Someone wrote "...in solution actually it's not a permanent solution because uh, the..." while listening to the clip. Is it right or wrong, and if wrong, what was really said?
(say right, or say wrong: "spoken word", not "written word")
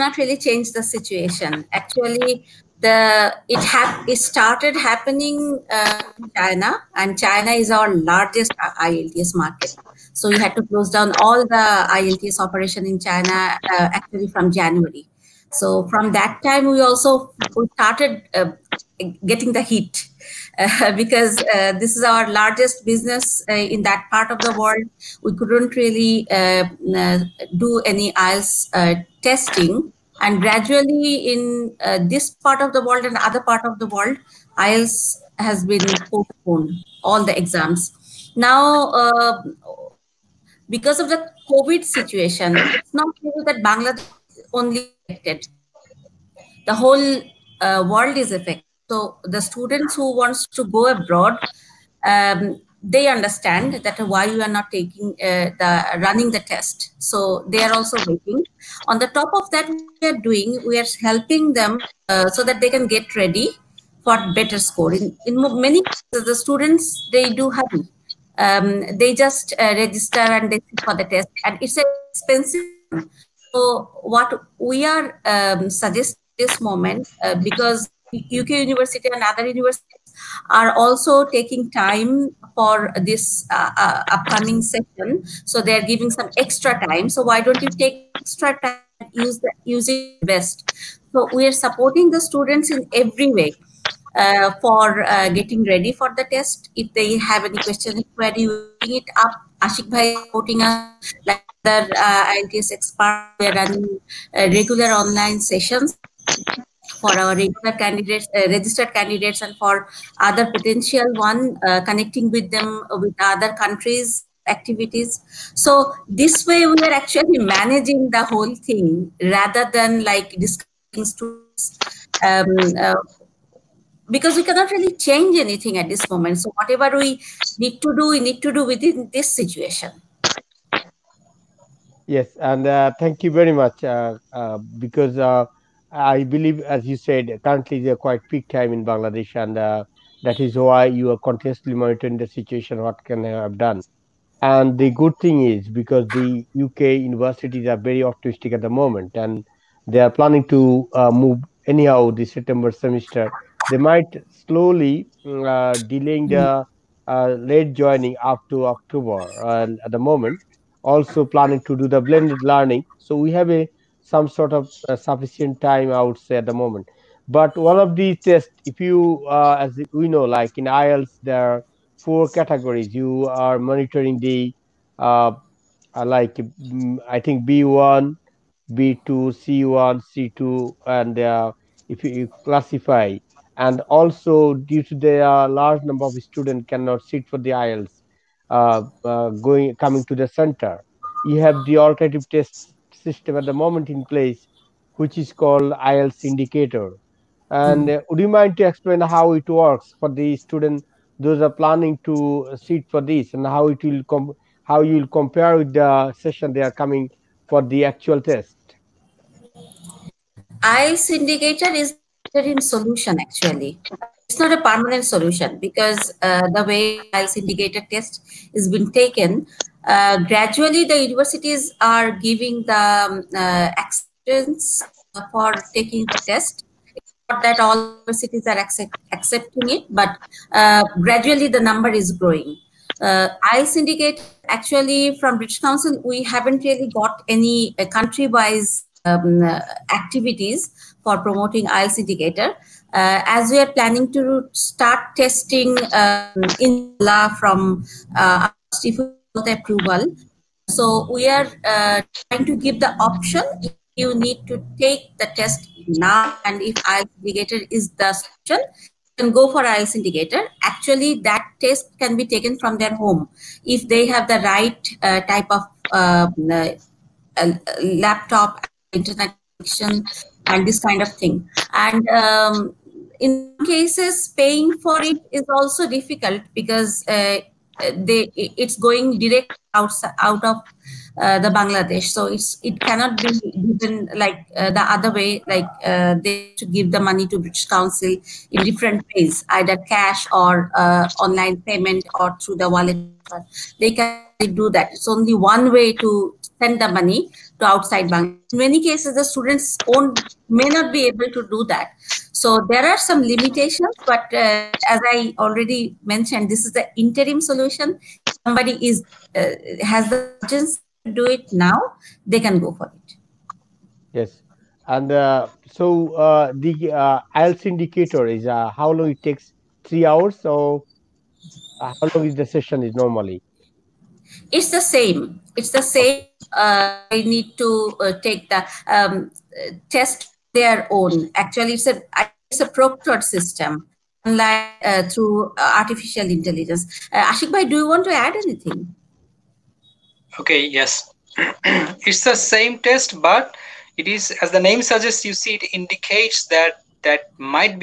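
right.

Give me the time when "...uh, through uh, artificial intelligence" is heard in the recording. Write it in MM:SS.
05:34.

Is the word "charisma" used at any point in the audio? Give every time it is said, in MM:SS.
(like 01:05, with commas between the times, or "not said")
not said.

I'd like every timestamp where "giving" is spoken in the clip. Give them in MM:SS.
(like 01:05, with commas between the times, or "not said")
01:25, 03:42.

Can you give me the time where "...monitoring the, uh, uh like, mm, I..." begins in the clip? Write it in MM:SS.
02:53.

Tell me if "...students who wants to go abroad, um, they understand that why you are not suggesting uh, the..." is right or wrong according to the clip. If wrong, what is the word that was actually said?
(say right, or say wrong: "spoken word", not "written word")
wrong: "taking", not "suggesting".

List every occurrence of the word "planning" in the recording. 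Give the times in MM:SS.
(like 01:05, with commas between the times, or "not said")
02:30, 02:41, 03:21, 04:03.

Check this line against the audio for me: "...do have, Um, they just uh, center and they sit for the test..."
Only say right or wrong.
wrong.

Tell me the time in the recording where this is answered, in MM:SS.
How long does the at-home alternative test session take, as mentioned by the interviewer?
05:19.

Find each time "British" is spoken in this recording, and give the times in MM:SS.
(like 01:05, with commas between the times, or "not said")
03:55, 04:47.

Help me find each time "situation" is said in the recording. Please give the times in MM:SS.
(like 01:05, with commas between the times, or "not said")
00:00, 00:41, 02:09, 02:22.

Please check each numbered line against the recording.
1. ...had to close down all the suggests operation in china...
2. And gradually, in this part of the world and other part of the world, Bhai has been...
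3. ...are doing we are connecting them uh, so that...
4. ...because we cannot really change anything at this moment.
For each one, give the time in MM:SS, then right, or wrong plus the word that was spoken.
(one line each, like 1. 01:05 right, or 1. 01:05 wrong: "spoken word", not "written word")
1. 00:10 wrong: "ielts", not "suggests"
2. 00:30 wrong: "IELTS", not "Bhai"
3. 01:00 wrong: "helping", not "connecting"
4. 02:04 right.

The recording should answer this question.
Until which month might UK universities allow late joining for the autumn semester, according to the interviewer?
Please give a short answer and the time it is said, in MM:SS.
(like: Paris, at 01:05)
October, at 02:38.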